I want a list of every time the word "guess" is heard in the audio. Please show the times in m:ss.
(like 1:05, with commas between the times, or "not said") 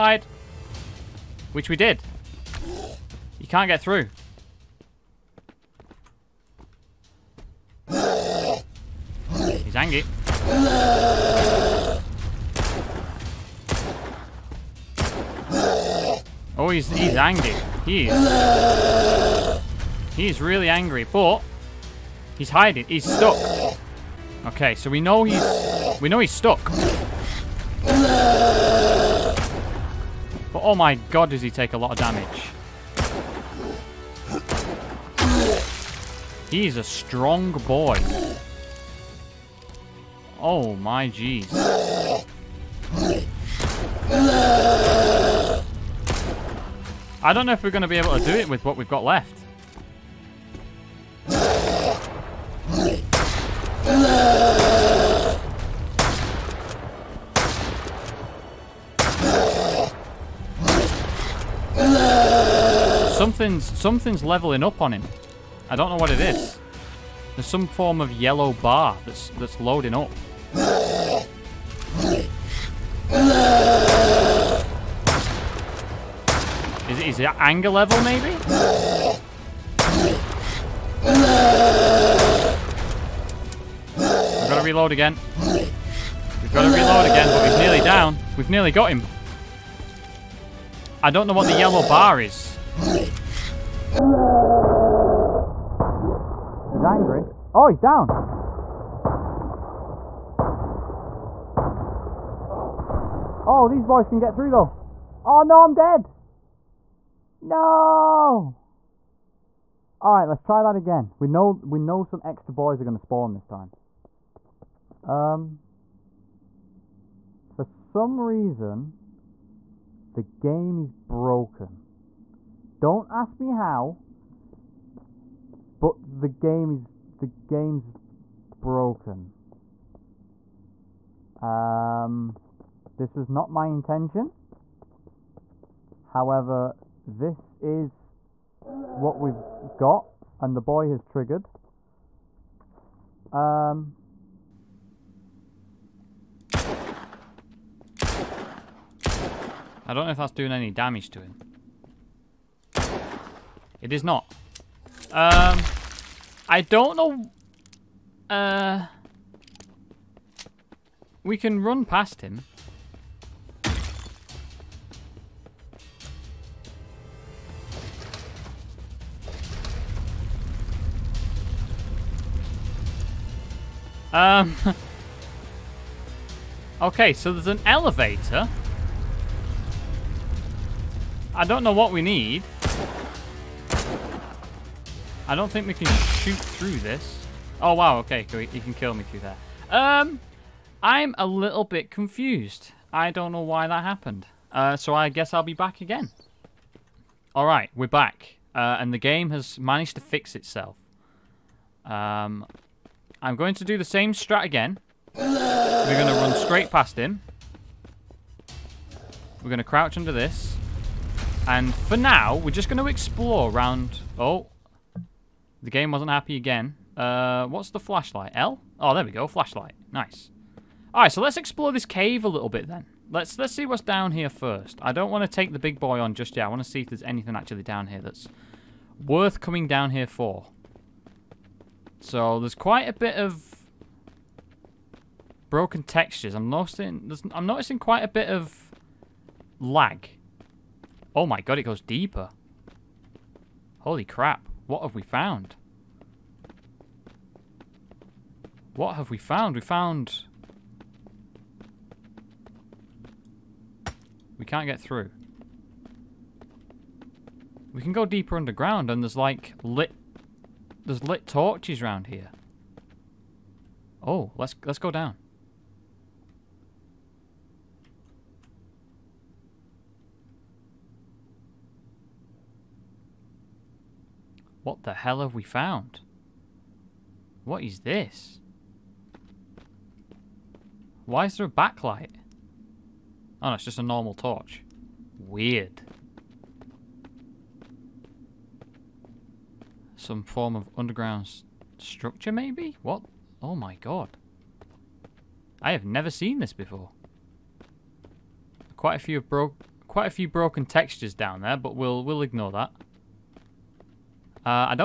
3:15.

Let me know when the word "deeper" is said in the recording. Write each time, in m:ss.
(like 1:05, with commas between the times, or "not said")
4:01, 4:18.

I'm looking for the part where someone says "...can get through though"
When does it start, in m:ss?
1:44.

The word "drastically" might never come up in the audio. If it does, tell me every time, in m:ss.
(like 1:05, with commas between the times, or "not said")
not said.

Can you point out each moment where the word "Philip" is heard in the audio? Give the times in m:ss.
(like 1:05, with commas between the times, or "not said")
not said.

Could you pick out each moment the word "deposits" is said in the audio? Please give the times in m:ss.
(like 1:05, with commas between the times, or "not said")
not said.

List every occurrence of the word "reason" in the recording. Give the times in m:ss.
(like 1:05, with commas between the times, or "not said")
1:58.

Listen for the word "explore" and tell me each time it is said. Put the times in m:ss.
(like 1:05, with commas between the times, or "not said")
3:32, 3:41.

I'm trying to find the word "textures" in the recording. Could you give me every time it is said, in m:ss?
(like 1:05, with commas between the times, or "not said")
3:55, 5:00.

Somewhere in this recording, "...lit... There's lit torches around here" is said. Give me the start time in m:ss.
4:19.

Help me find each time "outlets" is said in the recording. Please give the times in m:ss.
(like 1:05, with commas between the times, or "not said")
not said.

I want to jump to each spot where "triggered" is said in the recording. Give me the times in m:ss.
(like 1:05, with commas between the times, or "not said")
2:21.